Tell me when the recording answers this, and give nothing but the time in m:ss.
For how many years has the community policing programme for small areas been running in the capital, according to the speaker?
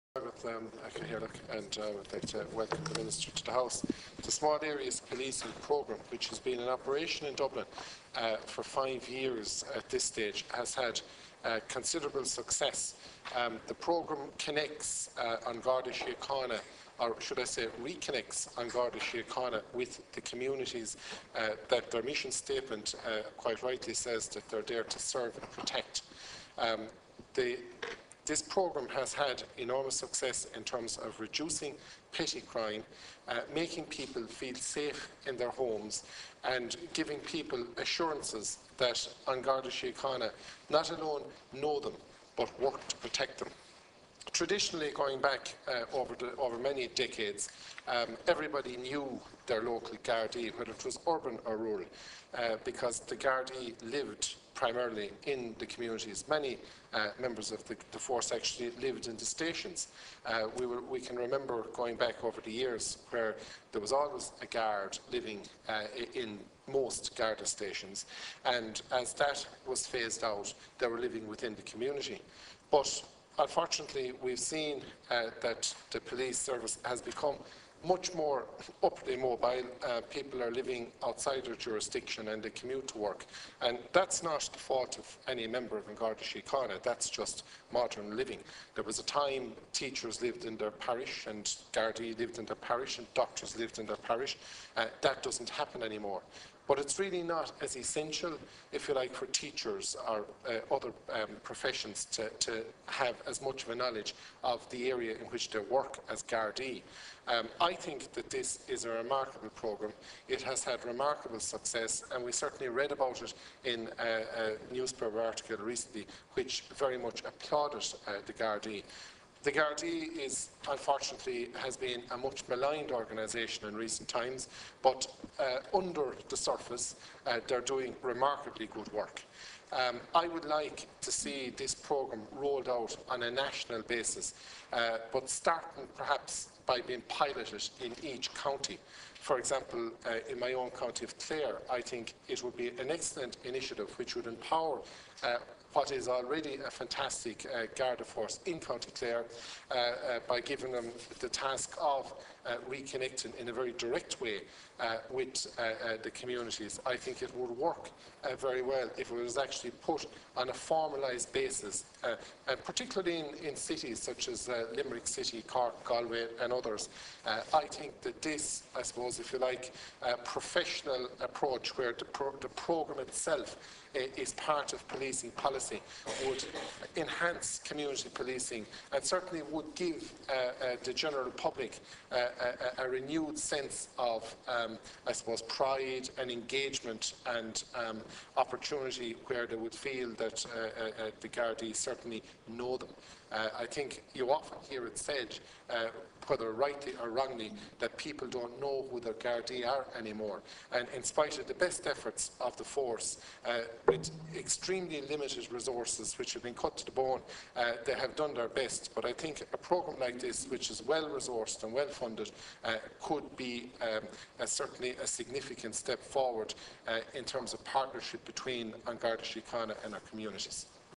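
0:08.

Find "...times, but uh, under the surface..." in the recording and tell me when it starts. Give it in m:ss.
2:04.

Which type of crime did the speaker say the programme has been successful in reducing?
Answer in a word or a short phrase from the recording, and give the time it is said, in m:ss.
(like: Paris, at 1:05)
Petty crime, at 0:32.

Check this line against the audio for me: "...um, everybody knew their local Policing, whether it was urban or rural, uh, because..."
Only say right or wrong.
wrong.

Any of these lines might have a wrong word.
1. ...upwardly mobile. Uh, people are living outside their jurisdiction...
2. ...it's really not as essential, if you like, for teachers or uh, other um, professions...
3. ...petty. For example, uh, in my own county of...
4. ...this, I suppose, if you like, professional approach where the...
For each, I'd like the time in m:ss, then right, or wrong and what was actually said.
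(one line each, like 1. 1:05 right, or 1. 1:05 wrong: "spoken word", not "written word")
1. 1:18 right
2. 1:36 right
3. 2:18 wrong: "county", not "petty"
4. 2:48 right.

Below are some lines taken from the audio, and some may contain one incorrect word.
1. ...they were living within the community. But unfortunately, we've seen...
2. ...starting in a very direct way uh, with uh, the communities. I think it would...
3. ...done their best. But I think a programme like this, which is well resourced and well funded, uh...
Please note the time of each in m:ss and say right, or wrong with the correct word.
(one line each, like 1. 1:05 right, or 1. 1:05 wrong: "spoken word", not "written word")
1. 1:10 right
2. 2:32 wrong: "reconnecting", not "starting"
3. 3:28 right.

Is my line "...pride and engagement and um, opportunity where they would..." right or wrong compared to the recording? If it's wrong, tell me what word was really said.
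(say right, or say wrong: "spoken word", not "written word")
right.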